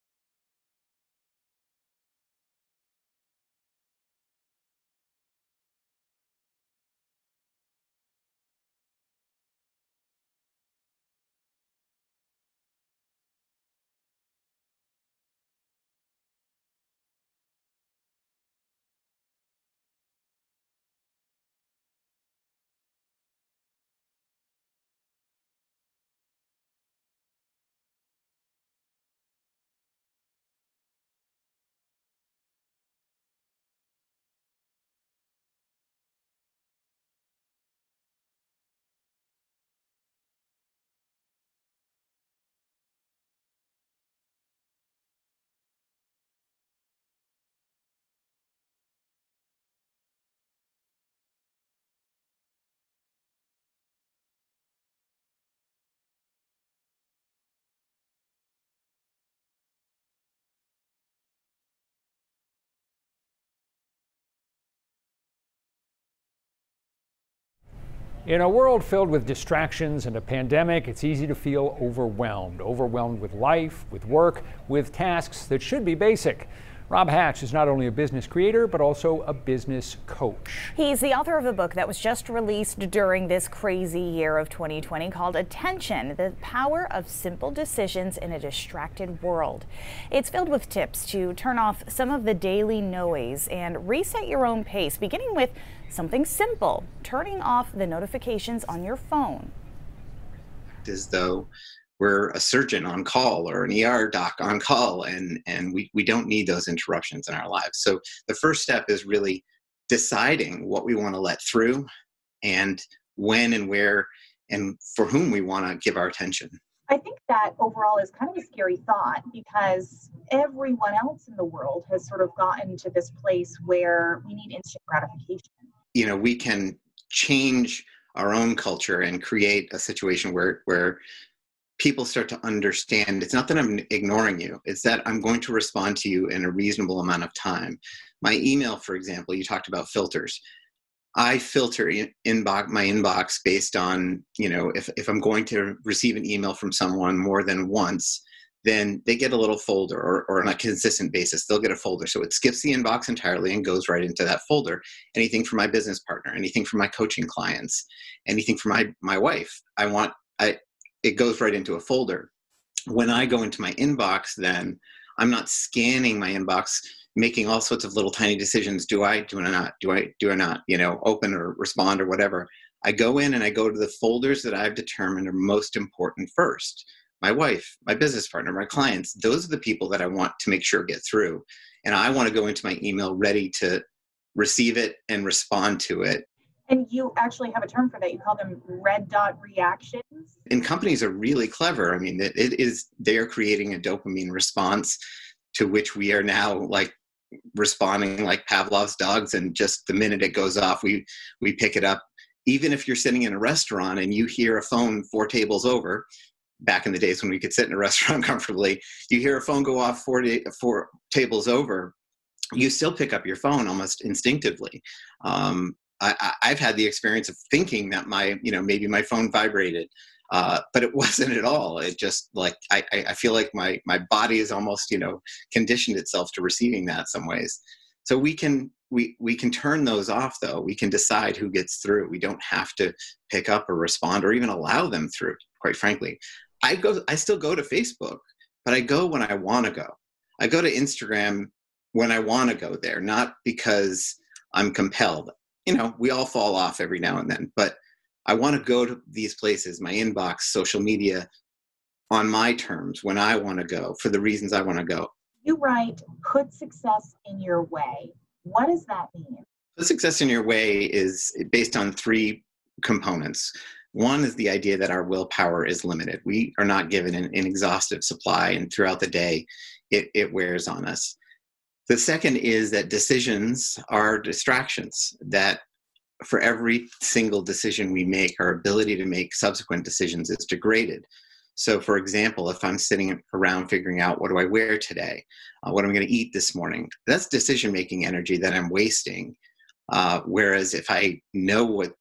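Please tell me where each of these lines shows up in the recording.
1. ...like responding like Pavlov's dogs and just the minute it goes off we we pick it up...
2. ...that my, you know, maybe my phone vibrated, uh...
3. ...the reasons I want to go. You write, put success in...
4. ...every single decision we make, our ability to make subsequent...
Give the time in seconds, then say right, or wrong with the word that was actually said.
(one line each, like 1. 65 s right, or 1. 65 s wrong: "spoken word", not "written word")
1. 196 s right
2. 217 s right
3. 254 s right
4. 276 s right.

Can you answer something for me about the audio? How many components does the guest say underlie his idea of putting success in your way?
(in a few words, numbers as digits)
3.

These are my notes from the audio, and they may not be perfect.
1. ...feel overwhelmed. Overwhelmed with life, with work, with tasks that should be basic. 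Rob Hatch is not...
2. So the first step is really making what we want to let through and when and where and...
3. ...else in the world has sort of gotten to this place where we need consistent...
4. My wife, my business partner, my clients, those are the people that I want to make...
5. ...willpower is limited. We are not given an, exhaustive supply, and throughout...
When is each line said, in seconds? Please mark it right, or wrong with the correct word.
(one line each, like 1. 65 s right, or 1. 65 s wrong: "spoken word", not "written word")
1. 71 s right
2. 107 s wrong: "deciding", not "making"
3. 121 s wrong: "instant", not "consistent"
4. 177 s right
5. 265 s right.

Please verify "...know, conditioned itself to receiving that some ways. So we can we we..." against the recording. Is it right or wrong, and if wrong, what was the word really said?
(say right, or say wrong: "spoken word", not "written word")
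right.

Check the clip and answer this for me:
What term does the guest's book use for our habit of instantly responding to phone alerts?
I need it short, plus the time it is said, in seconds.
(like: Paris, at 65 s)
Red dot reactions, at 188 s.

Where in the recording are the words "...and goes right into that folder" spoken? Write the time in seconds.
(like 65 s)
153 s.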